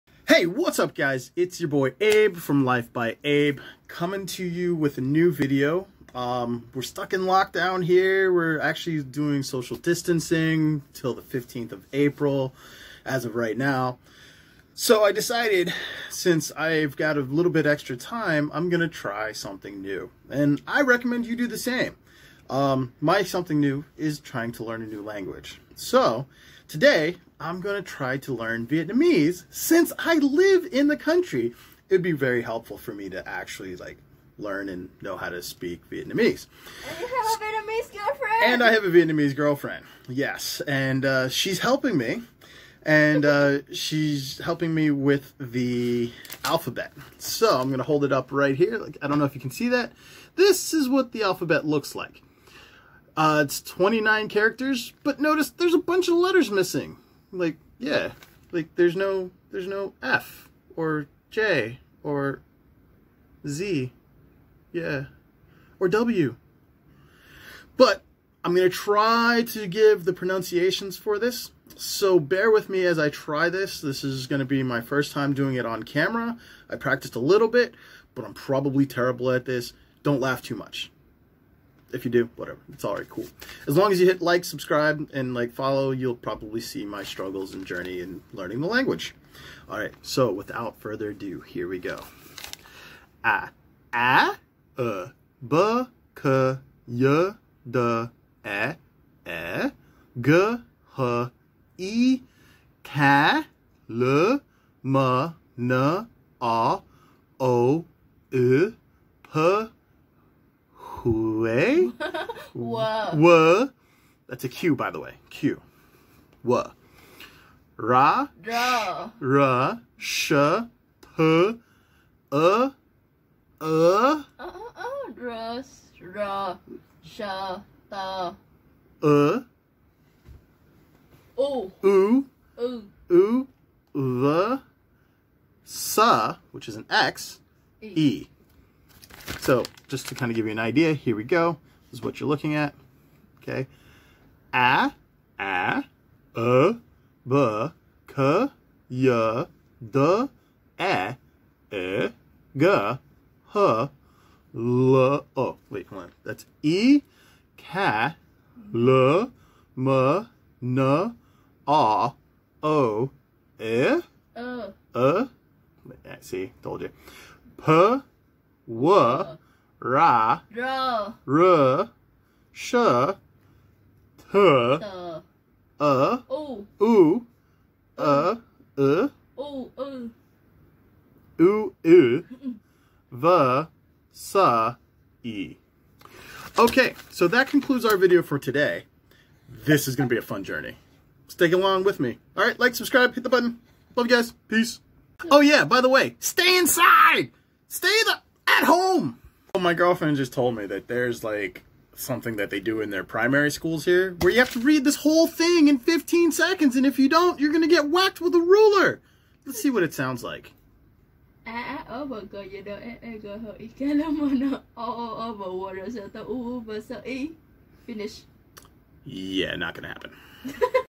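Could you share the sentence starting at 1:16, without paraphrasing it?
I practiced a little bit, but I'm probably terrible at this.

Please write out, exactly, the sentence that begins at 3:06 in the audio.
Okay, so that concludes our video for today.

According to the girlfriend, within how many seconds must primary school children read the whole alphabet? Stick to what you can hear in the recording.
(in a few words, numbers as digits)
15 seconds.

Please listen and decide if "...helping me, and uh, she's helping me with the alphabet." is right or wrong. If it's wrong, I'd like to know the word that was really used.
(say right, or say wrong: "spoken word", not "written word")
right.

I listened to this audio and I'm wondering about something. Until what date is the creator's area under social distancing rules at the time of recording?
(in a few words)
15th of April.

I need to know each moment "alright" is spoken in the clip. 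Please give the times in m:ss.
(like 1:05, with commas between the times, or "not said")
1:22, 1:29.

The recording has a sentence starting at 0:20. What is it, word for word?
And I recommend you do the same.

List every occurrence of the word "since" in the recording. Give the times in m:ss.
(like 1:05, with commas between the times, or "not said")
0:16, 0:29.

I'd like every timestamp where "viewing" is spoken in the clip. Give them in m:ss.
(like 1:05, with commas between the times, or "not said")
not said.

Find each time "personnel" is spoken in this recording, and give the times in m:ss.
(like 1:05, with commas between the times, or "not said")
not said.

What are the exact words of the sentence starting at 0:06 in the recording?
Um, we're stuck in lockdown here.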